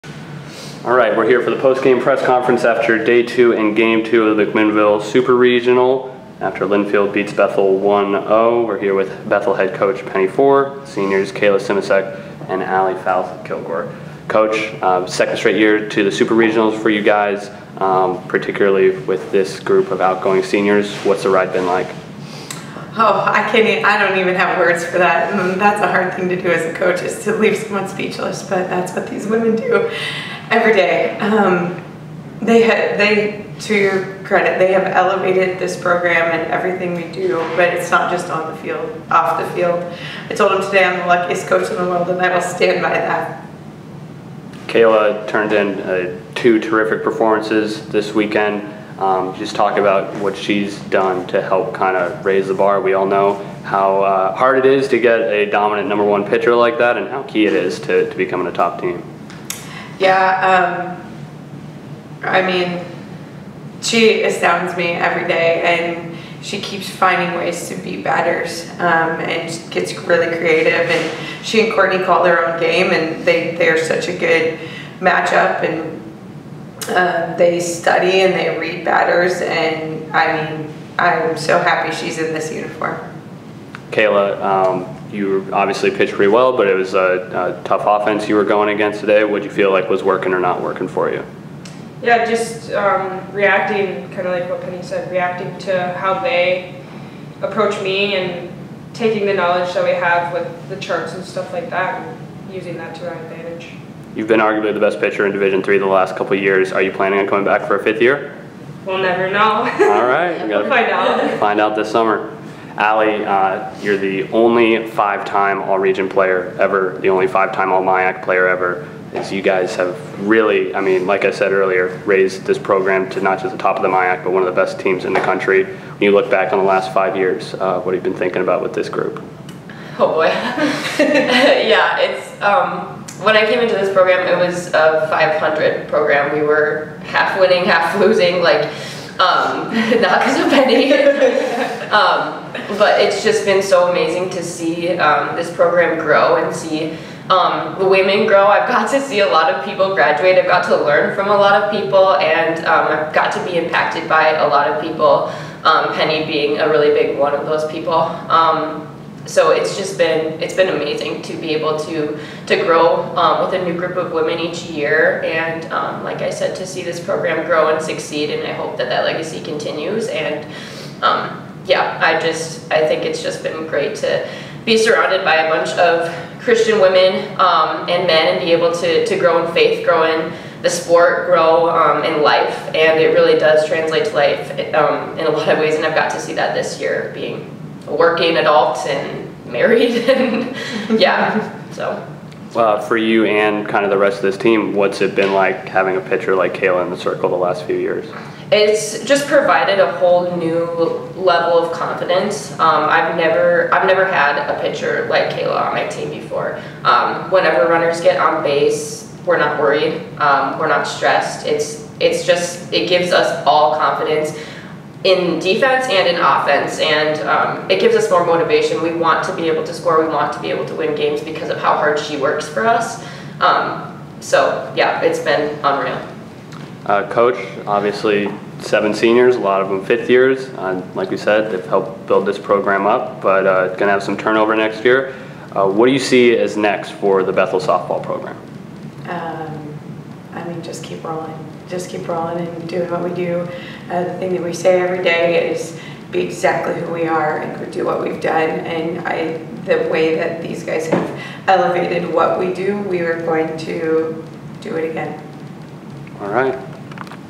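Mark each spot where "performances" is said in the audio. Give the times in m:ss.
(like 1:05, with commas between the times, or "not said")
0:47.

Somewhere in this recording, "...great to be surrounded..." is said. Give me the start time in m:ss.
2:53.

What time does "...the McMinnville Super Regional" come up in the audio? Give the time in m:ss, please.
0:04.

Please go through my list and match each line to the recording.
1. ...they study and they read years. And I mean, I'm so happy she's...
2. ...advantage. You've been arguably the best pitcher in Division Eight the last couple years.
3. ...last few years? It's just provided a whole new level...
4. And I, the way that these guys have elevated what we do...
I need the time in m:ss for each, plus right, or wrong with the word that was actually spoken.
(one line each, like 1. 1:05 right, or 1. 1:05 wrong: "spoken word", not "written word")
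1. 1:17 wrong: "batters", not "years"
2. 1:43 wrong: "Three", not "Eight"
3. 3:17 right
4. 4:08 right.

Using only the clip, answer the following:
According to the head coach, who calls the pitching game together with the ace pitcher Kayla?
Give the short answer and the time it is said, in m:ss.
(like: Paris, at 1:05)
Courtney, at 1:11.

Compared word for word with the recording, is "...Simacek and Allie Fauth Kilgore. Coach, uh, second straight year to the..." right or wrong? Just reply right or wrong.
right.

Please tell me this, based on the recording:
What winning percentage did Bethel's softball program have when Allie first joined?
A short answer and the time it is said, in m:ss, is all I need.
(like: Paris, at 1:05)
500, at 2:15.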